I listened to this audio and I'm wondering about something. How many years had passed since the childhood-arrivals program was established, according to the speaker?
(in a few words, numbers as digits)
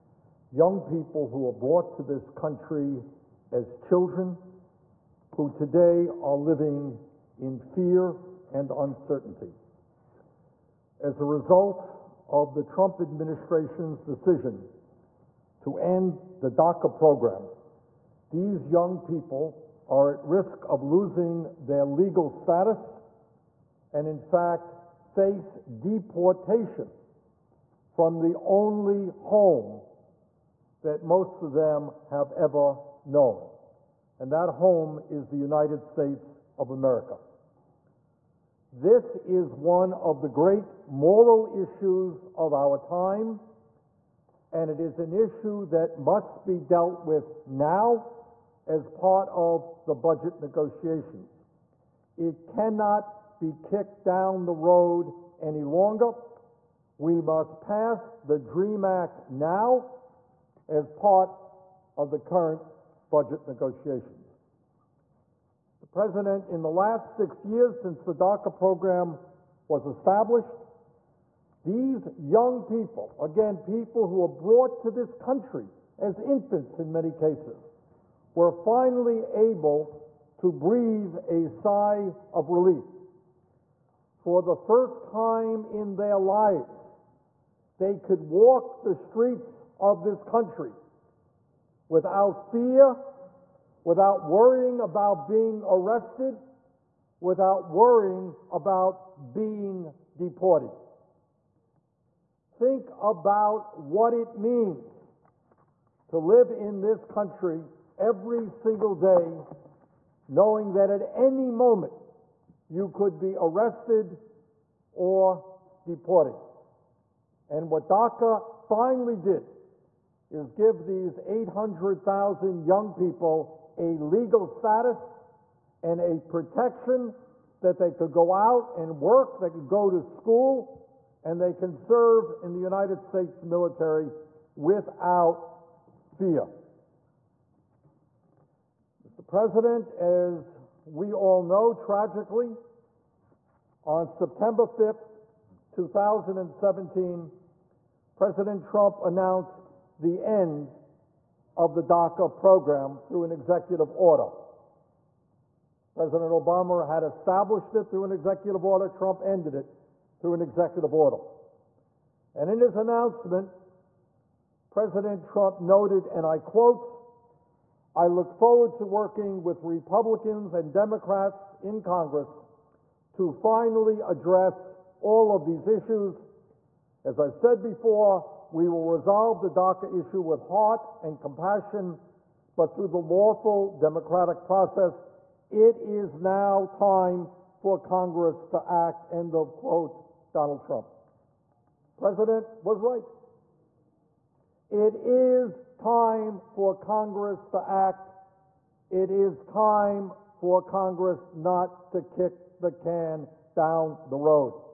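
6.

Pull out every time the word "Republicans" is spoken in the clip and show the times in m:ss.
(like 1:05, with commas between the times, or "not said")
2:49.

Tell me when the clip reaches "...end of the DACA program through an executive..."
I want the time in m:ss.
2:30.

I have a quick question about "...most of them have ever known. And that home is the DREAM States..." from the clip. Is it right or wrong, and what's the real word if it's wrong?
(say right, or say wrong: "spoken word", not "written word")
wrong: "United", not "DREAM".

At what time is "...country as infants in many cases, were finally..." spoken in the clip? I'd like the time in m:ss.
1:15.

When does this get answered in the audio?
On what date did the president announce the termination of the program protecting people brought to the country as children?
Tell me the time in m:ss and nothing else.
2:24.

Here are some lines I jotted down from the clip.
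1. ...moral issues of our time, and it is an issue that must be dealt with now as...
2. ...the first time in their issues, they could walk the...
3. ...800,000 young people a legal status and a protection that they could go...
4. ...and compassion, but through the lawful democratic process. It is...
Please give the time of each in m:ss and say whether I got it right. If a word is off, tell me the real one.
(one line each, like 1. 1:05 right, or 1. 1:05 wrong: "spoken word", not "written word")
1. 0:40 right
2. 1:24 wrong: "lives", not "issues"
3. 2:01 right
4. 3:01 right.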